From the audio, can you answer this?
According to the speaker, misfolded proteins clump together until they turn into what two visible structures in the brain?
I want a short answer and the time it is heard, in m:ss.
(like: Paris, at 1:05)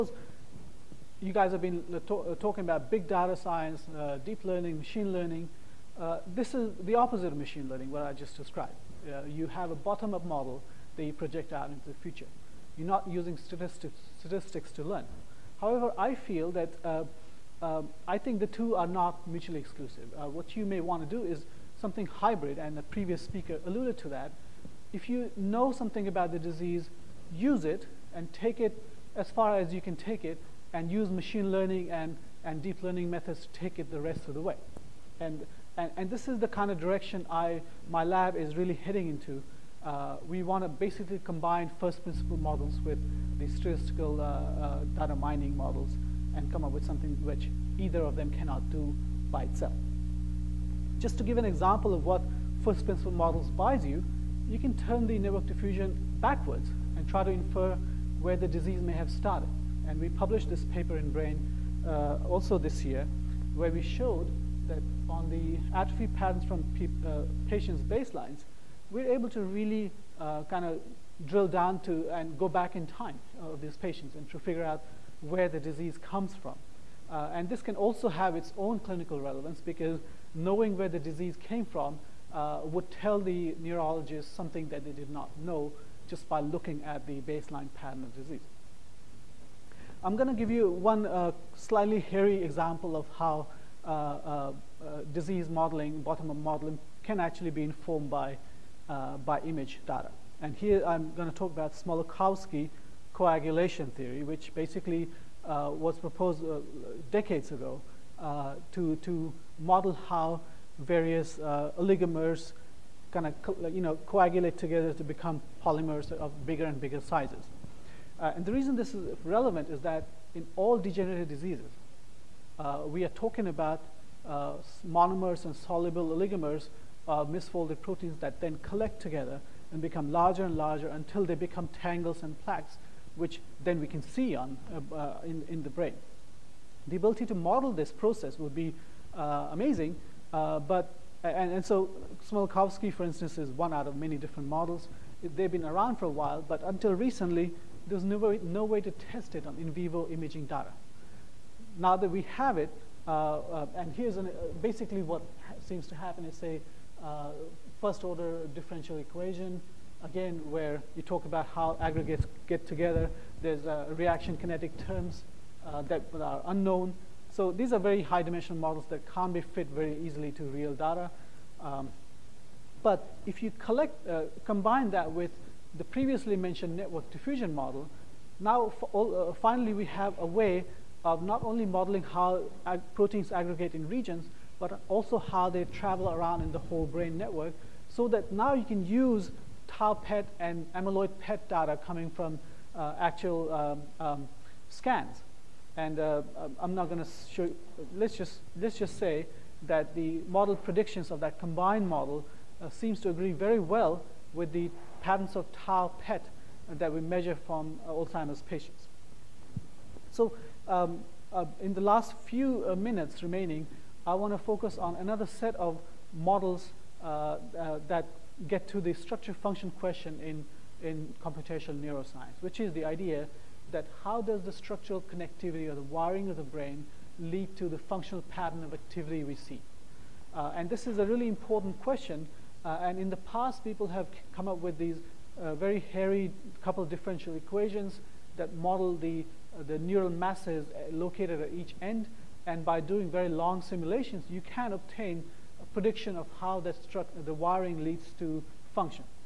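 tangles and plaques, at 2:11.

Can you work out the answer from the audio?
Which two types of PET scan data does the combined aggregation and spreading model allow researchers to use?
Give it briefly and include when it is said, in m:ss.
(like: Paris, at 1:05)
tau PET and amyloid PET, at 3:09.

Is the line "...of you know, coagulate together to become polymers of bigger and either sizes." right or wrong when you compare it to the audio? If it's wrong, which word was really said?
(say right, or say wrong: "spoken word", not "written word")
wrong: "bigger", not "either".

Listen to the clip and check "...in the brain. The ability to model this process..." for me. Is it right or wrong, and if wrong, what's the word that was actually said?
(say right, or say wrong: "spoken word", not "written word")
right.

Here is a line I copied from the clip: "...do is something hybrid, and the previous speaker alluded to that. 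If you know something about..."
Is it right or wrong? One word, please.
right.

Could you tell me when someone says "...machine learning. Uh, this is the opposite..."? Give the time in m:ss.
0:04.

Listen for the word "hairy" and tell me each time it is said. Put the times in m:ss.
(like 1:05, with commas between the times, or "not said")
1:32, 3:55.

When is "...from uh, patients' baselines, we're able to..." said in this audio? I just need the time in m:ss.
1:06.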